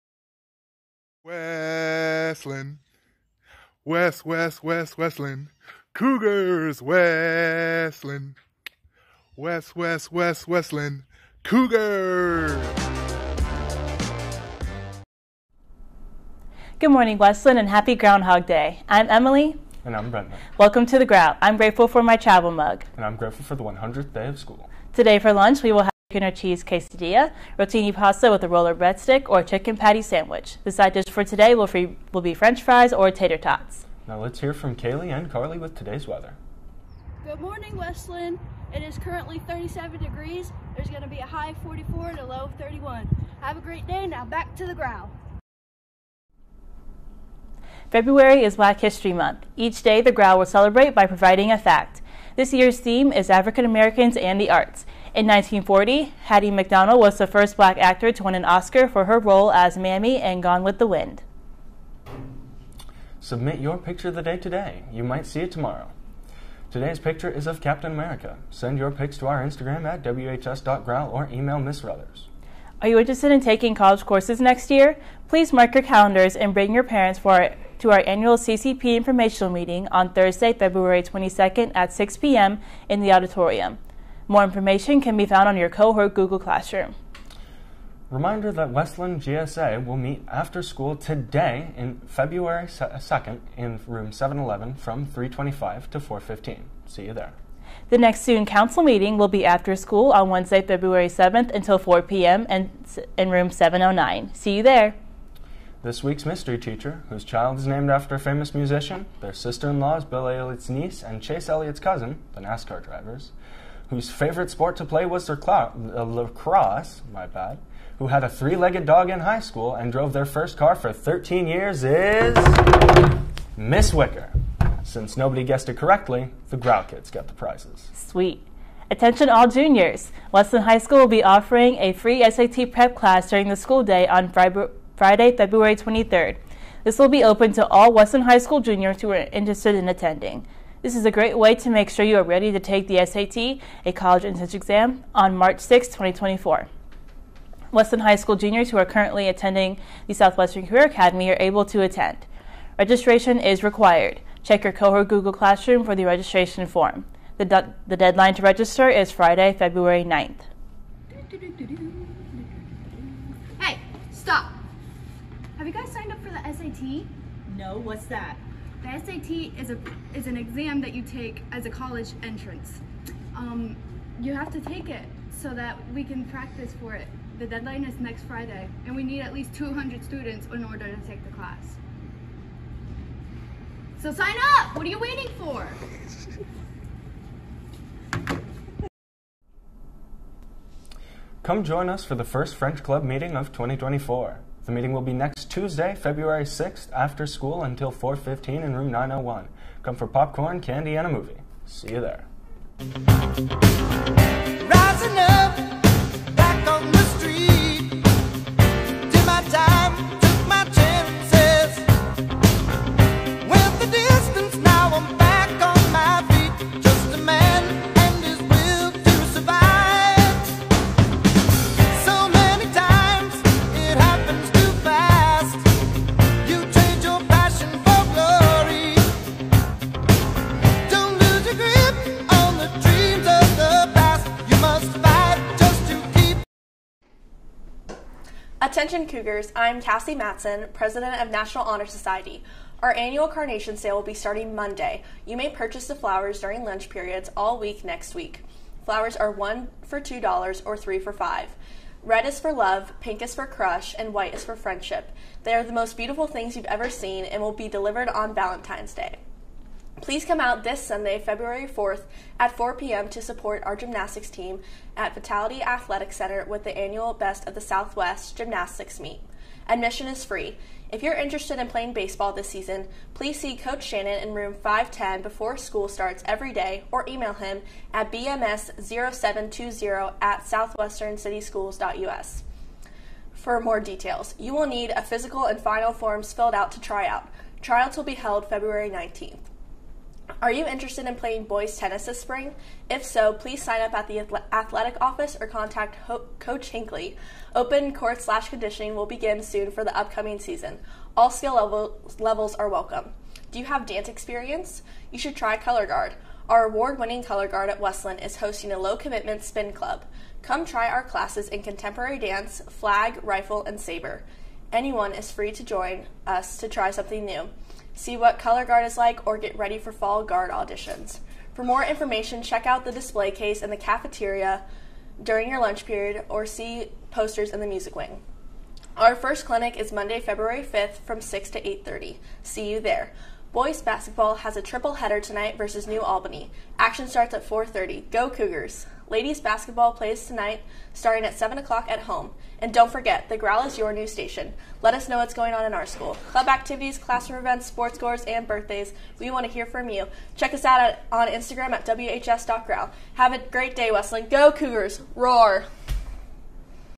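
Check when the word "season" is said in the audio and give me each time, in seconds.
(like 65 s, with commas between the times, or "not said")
272 s, 300 s.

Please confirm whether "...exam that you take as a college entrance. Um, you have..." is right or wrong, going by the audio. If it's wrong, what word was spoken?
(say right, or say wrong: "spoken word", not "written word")
right.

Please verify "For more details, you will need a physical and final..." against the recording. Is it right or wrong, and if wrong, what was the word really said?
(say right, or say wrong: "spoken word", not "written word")
right.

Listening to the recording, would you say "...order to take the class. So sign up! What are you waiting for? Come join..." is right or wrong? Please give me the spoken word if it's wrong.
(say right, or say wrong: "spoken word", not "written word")
right.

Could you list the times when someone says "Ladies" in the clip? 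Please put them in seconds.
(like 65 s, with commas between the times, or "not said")
339 s.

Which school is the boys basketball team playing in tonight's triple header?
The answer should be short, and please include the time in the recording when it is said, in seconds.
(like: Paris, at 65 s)
New Albany, at 335 s.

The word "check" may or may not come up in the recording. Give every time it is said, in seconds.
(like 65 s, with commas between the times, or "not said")
154 s, 322 s, 350 s.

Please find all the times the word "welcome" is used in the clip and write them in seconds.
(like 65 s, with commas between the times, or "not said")
20 s, 302 s.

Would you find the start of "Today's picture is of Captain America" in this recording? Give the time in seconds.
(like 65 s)
66 s.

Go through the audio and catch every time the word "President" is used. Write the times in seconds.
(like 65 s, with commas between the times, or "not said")
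240 s.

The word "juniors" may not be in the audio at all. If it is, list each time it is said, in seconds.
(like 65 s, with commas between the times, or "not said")
129 s, 138 s, 148 s.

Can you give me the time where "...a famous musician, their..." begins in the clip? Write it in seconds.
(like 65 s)
108 s.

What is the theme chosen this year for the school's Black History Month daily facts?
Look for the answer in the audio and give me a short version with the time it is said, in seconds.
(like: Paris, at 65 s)
African Americans and the Arts, at 53 s.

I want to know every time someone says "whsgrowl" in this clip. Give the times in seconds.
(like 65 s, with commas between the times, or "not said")
70 s, 351 s.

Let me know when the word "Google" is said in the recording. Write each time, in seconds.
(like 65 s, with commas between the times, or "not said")
86 s, 155 s.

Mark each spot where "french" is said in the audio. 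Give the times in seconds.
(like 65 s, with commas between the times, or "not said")
32 s, 192 s.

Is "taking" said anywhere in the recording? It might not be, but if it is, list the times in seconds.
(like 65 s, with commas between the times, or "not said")
73 s.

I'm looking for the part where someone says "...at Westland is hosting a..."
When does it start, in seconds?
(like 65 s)
307 s.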